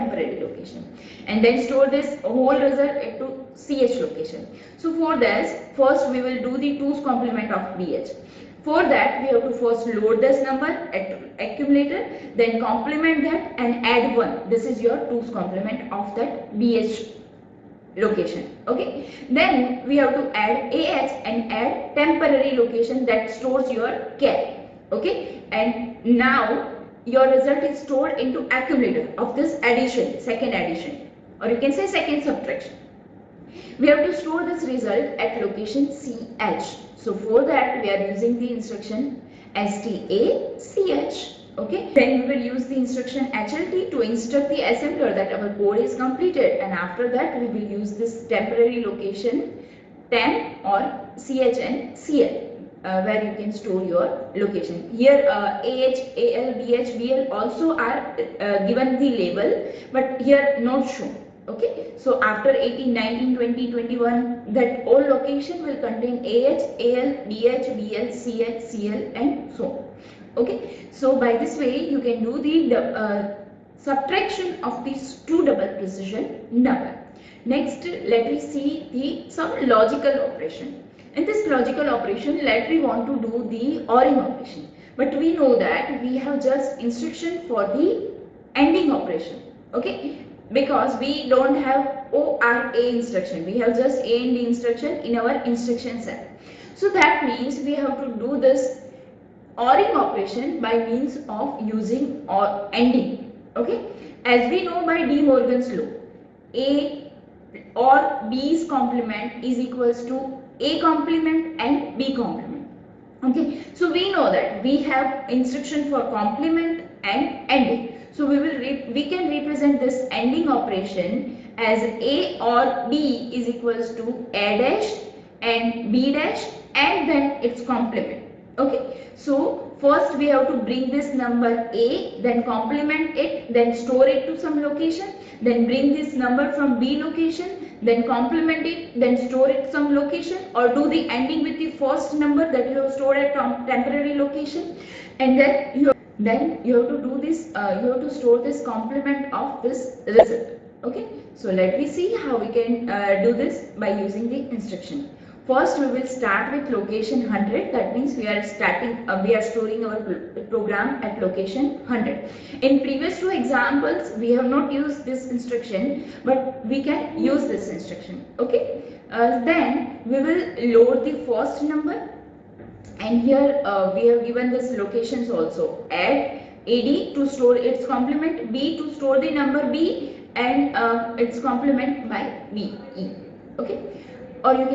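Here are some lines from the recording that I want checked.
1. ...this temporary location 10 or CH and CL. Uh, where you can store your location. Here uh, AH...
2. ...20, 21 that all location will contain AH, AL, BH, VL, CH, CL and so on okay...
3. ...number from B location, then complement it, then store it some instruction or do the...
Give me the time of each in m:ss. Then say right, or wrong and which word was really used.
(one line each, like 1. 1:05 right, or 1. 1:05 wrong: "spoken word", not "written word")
1. 0:47 right
2. 1:03 right
3. 2:16 wrong: "location", not "instruction".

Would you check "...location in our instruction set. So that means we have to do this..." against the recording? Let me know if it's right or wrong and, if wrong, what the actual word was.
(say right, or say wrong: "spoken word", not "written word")
wrong: "instruction", not "location".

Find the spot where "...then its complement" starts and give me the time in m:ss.
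2:07.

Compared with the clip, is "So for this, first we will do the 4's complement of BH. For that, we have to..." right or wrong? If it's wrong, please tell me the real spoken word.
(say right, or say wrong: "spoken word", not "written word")
wrong: "2", not "4".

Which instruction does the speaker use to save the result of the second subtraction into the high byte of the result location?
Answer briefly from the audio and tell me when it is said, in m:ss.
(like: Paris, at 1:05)
STA CH, at 0:39.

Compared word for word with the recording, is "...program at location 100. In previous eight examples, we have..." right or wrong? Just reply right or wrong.
wrong.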